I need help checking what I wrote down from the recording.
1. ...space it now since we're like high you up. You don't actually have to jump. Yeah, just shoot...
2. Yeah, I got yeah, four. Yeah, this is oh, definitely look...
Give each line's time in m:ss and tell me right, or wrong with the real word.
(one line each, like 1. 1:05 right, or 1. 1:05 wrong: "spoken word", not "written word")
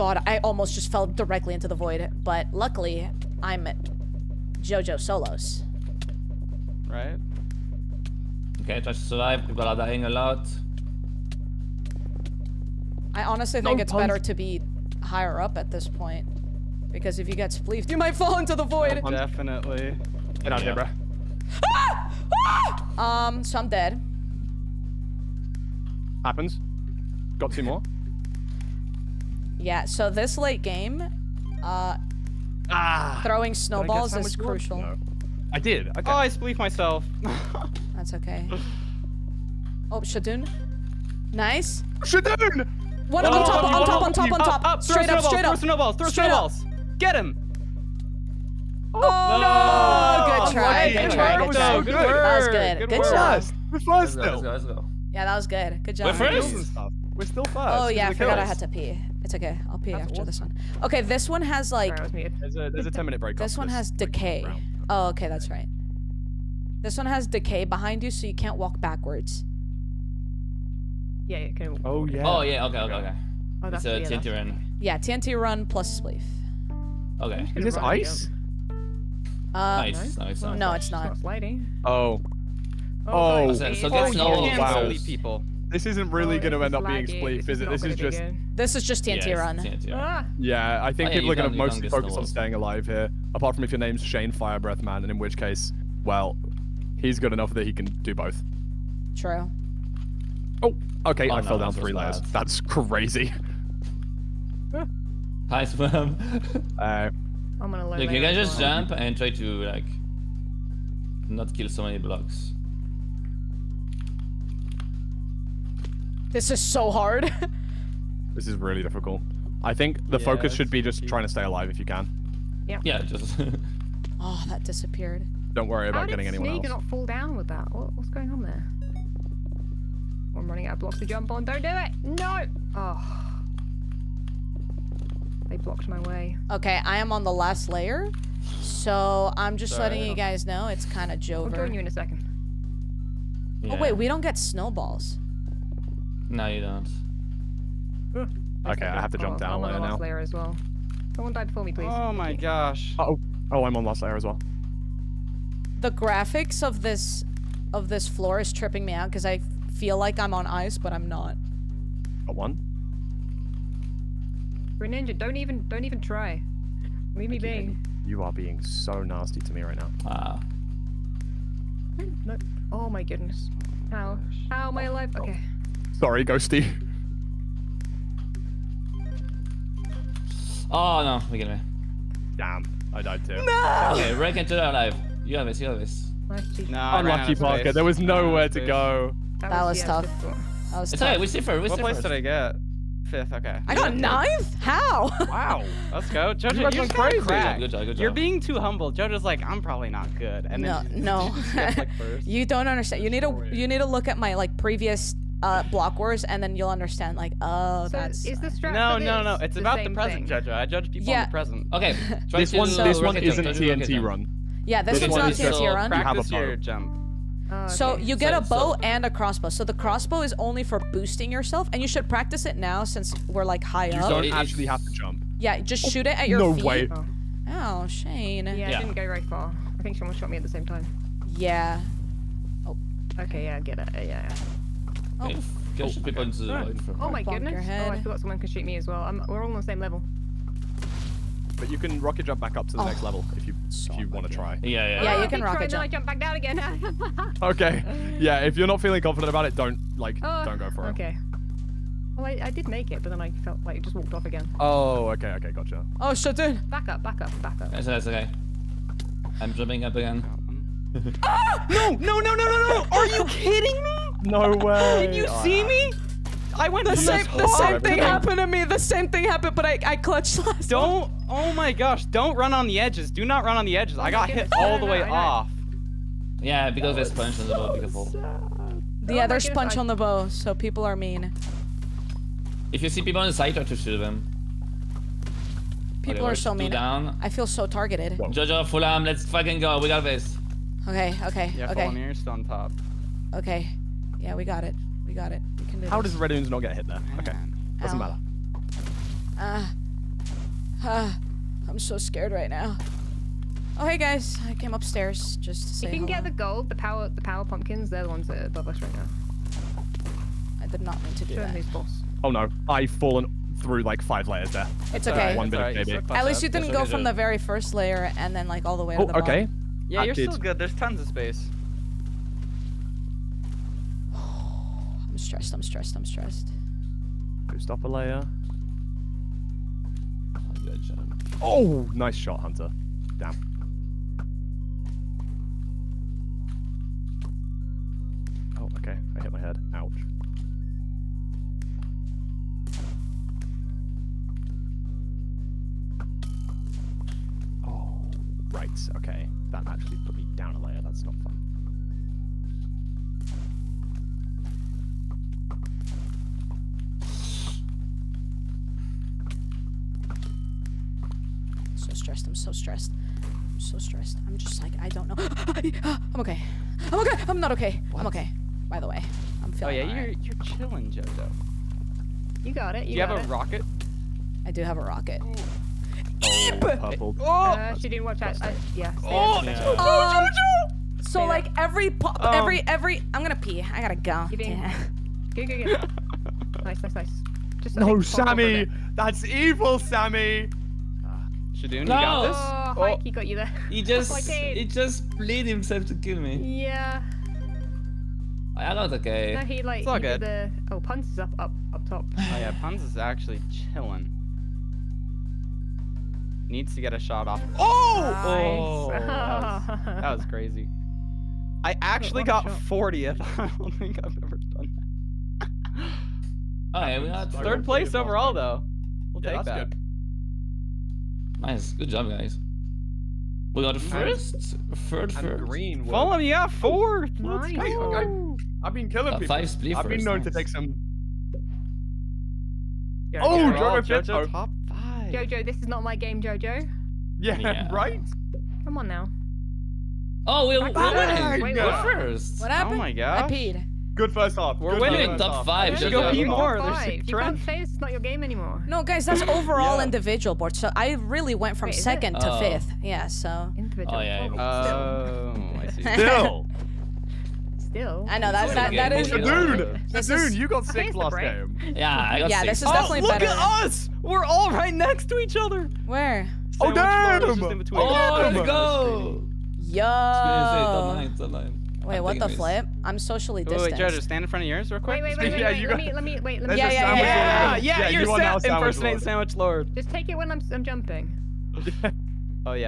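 1. 3:42 wrong: "practice", not "space"
2. 7:41 wrong: "six", not "four".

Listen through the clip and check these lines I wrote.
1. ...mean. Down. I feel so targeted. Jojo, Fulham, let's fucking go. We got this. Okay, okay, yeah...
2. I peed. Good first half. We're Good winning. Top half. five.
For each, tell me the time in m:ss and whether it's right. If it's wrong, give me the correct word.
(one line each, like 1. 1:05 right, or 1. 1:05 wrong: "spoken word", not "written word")
1. 4:46 right
2. 7:23 right.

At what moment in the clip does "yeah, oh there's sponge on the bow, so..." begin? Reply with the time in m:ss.
4:39.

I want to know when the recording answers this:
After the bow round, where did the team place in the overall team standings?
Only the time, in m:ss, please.
6:57.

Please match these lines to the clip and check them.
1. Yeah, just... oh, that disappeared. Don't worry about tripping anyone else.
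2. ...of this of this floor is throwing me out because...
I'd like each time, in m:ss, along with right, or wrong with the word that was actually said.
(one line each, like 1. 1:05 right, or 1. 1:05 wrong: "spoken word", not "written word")
1. 2:02 wrong: "getting", not "tripping"
2. 2:36 wrong: "tripping", not "throwing".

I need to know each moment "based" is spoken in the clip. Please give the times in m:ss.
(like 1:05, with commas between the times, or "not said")
not said.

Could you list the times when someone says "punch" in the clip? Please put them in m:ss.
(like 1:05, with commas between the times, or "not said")
0:13, 4:37.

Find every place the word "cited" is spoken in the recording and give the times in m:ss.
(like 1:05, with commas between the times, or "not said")
not said.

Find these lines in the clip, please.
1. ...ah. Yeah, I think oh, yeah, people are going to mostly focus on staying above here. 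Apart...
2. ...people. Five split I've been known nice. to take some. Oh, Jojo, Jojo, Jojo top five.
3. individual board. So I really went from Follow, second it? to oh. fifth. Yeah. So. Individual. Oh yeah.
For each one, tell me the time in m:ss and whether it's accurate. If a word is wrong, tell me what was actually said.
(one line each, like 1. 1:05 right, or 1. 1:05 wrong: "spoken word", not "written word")
1. 1:29 wrong: "alive", not "above"
2. 7:09 right
3. 7:29 wrong: "Wait", not "Follow".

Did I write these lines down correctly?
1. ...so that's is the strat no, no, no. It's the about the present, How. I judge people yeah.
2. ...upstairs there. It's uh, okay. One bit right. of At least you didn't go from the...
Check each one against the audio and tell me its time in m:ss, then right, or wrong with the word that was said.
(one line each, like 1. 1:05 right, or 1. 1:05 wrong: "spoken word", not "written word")
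1. 3:27 wrong: "Jojo", not "How"
2. 5:14 wrong: "layers", not "upstairs".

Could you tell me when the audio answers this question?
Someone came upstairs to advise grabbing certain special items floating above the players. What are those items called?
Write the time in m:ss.
5:07.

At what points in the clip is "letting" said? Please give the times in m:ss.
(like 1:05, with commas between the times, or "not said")
2:19.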